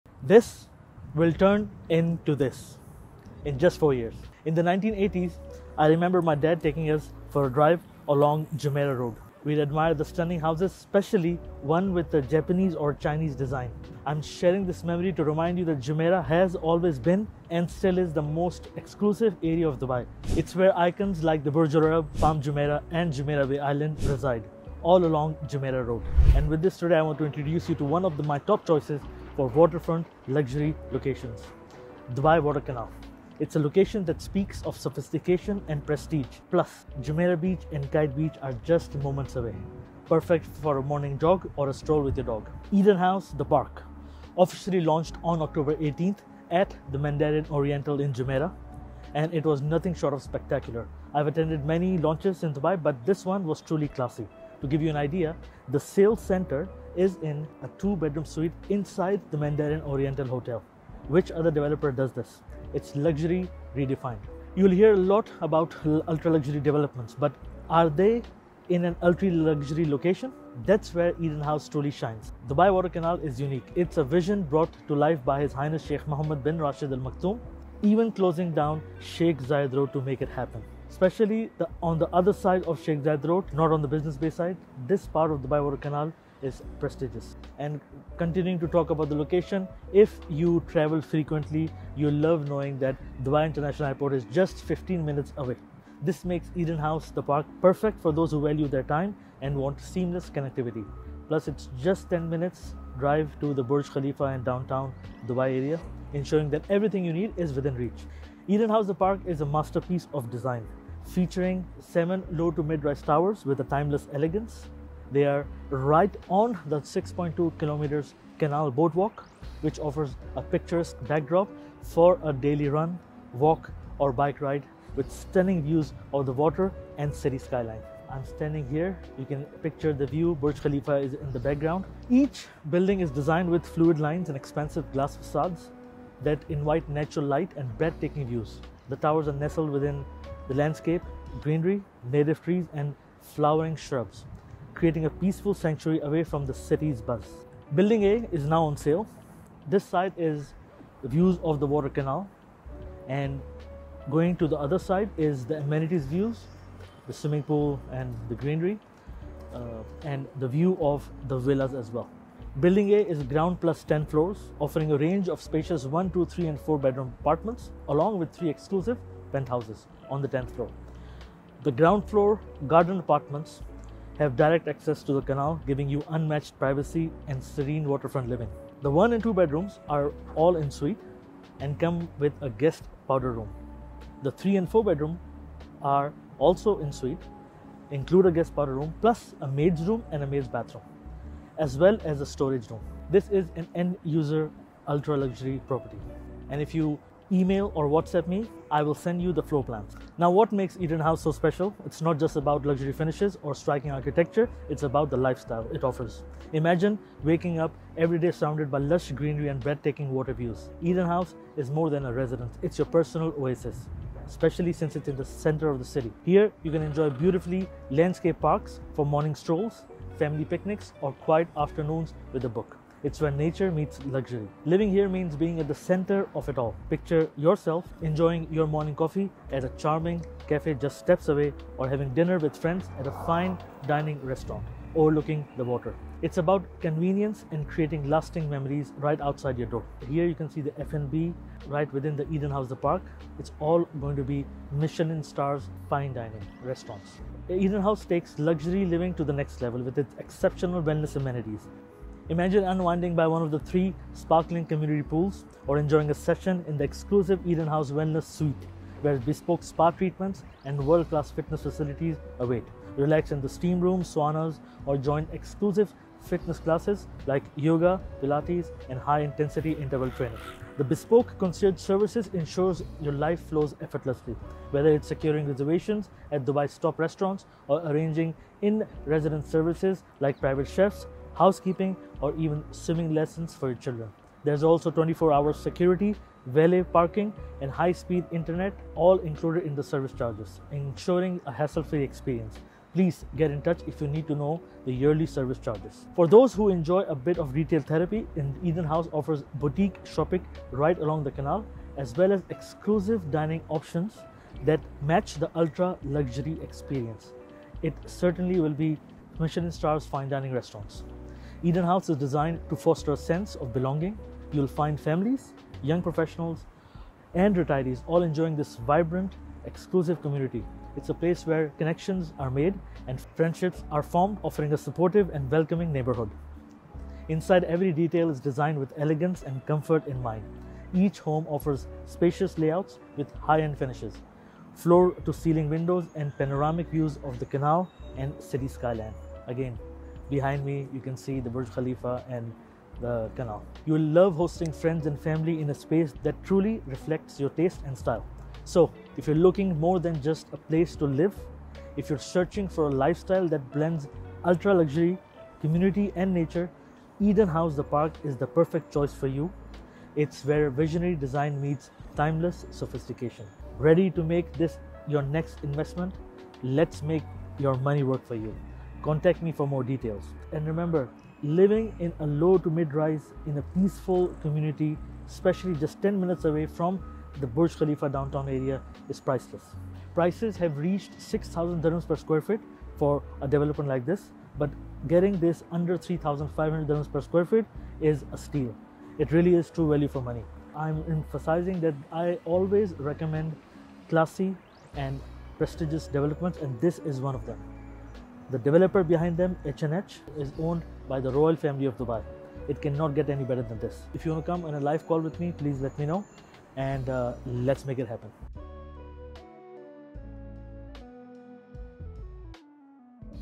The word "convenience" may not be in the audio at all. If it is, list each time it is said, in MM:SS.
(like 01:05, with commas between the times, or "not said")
03:56.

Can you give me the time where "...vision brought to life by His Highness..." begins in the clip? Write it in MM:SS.
01:14.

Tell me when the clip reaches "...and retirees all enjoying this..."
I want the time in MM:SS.
05:17.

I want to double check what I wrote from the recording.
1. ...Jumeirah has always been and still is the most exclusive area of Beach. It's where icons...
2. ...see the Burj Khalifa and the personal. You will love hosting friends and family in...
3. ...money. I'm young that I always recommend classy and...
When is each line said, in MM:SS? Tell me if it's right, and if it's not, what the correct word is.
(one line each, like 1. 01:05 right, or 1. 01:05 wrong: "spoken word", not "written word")
1. 00:15 wrong: "Dubai", not "Beach"
2. 05:41 wrong: "canal", not "personal"
3. 06:30 wrong: "emphasizing", not "young".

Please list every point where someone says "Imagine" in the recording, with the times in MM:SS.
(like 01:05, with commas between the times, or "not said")
03:26, 04:12.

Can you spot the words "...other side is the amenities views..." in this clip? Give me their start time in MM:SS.
02:34.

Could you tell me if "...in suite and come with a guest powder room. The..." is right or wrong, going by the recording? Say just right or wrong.
right.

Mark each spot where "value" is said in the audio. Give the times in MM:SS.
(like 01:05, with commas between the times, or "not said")
01:38, 06:29.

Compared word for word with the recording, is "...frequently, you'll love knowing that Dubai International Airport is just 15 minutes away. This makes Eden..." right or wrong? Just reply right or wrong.
right.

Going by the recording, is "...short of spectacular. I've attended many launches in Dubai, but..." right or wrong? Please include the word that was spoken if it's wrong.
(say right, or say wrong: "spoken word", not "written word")
right.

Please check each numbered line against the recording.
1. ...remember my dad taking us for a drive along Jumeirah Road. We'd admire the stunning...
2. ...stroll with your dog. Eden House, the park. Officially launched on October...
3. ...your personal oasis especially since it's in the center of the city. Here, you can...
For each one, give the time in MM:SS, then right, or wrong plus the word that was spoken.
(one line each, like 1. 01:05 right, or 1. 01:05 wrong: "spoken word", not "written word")
1. 00:05 right
2. 00:41 right
3. 03:32 right.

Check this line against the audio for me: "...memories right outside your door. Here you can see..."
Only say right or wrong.
right.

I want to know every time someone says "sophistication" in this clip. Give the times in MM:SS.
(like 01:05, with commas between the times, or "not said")
00:34, 06:02.